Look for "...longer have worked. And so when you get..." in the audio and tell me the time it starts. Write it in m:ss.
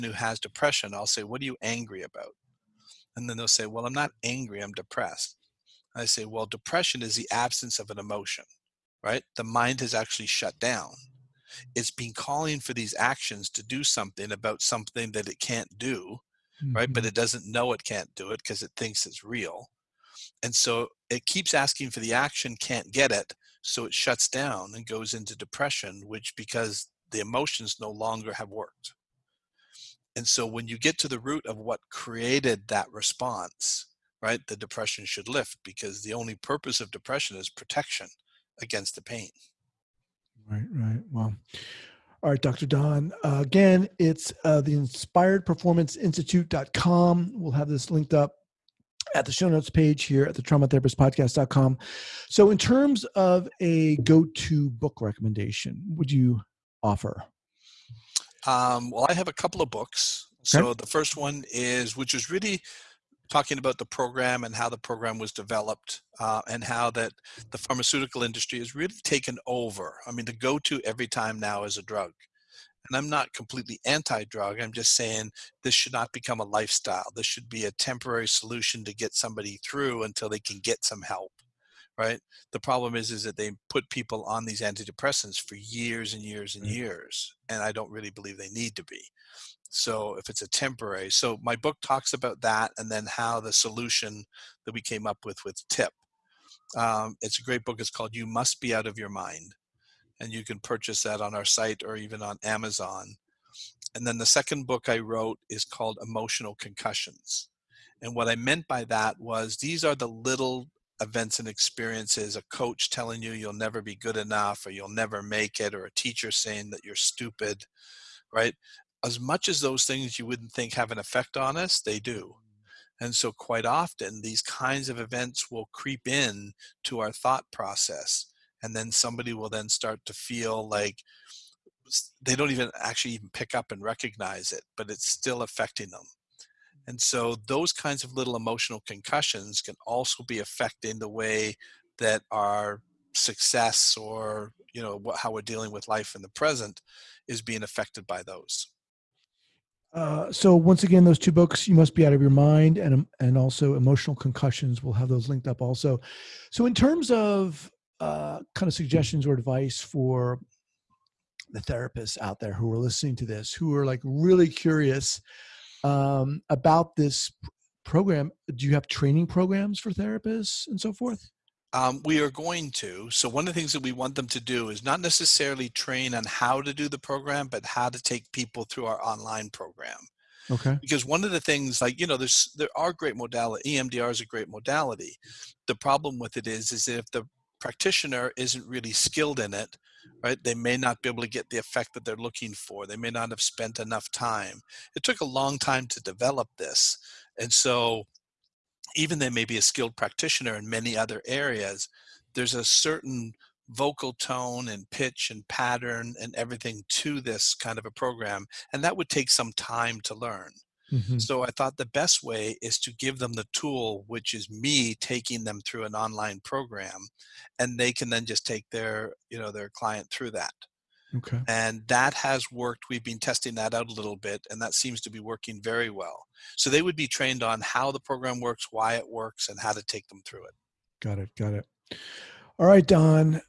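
0:27.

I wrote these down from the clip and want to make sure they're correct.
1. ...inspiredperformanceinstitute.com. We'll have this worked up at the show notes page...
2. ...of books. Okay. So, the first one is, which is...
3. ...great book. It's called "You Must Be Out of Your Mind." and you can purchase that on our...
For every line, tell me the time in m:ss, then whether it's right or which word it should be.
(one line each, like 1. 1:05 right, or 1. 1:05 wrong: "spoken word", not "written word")
1. 0:44 wrong: "linked", not "worked"
2. 0:59 right
3. 1:37 right.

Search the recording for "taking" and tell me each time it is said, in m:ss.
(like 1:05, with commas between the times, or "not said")
3:34.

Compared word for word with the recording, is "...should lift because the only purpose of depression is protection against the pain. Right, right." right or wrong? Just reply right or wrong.
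right.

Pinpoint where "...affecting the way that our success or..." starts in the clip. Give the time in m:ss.
2:20.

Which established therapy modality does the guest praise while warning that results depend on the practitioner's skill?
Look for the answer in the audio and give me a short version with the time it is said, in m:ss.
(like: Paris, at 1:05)
EMDR, at 3:03.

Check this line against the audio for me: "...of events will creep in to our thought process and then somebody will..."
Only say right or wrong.
right.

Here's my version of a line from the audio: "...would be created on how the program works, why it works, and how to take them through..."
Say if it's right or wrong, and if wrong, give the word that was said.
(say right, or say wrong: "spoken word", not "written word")
wrong: "trained", not "created".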